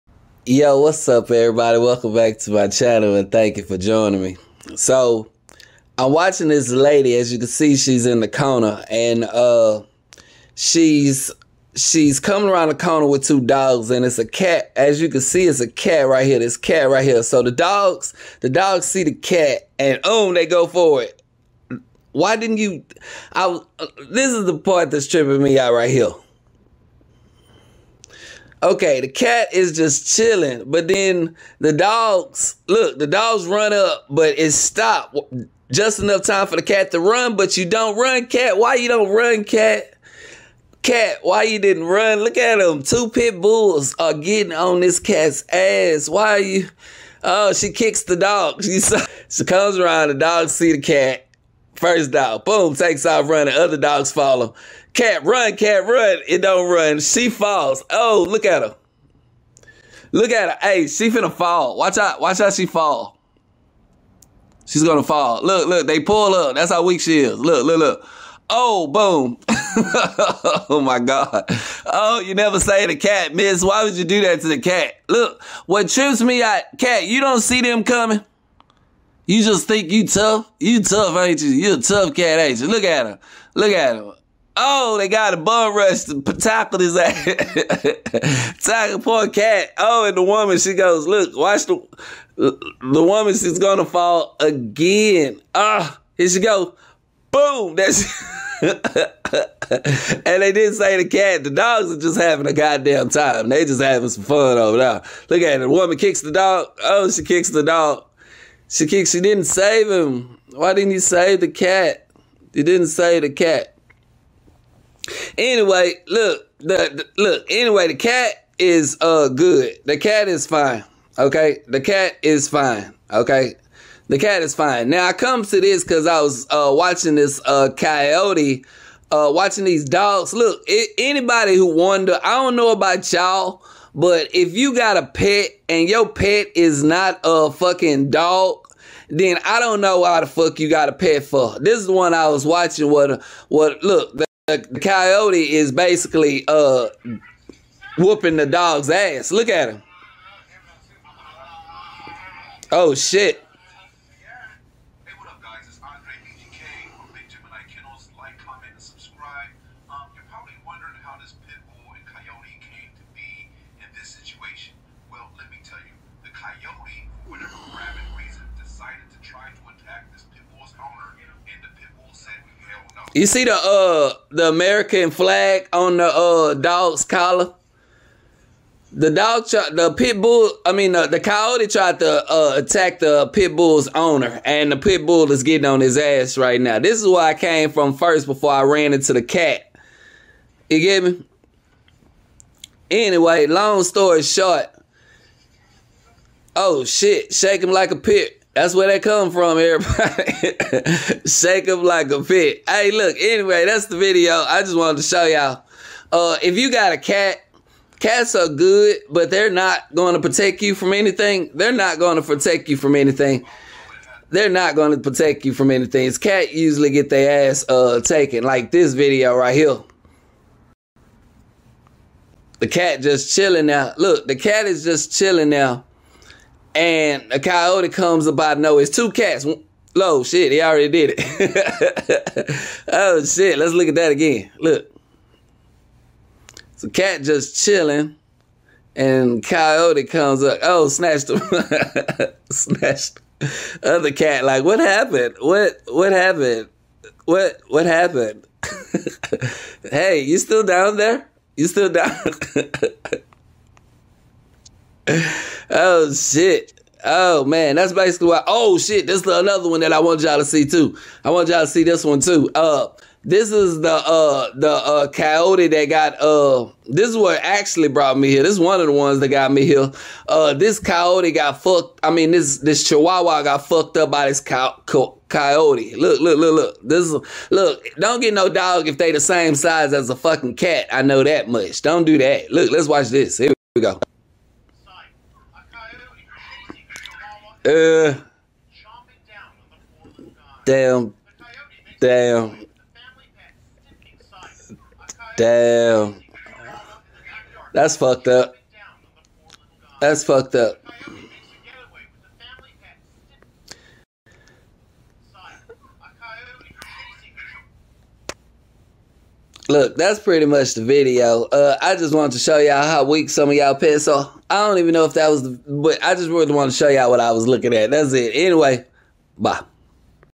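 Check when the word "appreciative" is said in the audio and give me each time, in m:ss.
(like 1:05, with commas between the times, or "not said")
not said.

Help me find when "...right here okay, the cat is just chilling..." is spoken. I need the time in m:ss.
0:25.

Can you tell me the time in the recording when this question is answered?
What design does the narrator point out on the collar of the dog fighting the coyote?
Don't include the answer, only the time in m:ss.
2:54.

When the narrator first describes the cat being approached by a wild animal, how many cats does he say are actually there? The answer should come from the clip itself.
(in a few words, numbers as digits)
2.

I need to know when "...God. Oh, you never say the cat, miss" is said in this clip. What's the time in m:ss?
1:10.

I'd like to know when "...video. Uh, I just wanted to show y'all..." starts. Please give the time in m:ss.
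5:10.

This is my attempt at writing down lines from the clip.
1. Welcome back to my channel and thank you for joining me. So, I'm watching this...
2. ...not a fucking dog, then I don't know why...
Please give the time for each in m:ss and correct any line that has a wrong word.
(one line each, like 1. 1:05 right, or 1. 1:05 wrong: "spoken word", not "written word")
1. 0:01 right
2. 2:16 right.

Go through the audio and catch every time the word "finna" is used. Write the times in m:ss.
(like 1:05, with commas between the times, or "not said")
1:01.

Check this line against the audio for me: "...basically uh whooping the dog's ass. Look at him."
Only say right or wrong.
right.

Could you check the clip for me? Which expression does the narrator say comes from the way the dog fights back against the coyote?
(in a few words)
Shake them like a pit.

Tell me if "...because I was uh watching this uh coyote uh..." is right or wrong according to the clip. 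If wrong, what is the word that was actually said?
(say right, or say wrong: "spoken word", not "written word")
right.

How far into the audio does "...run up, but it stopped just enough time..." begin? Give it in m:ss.
0:33.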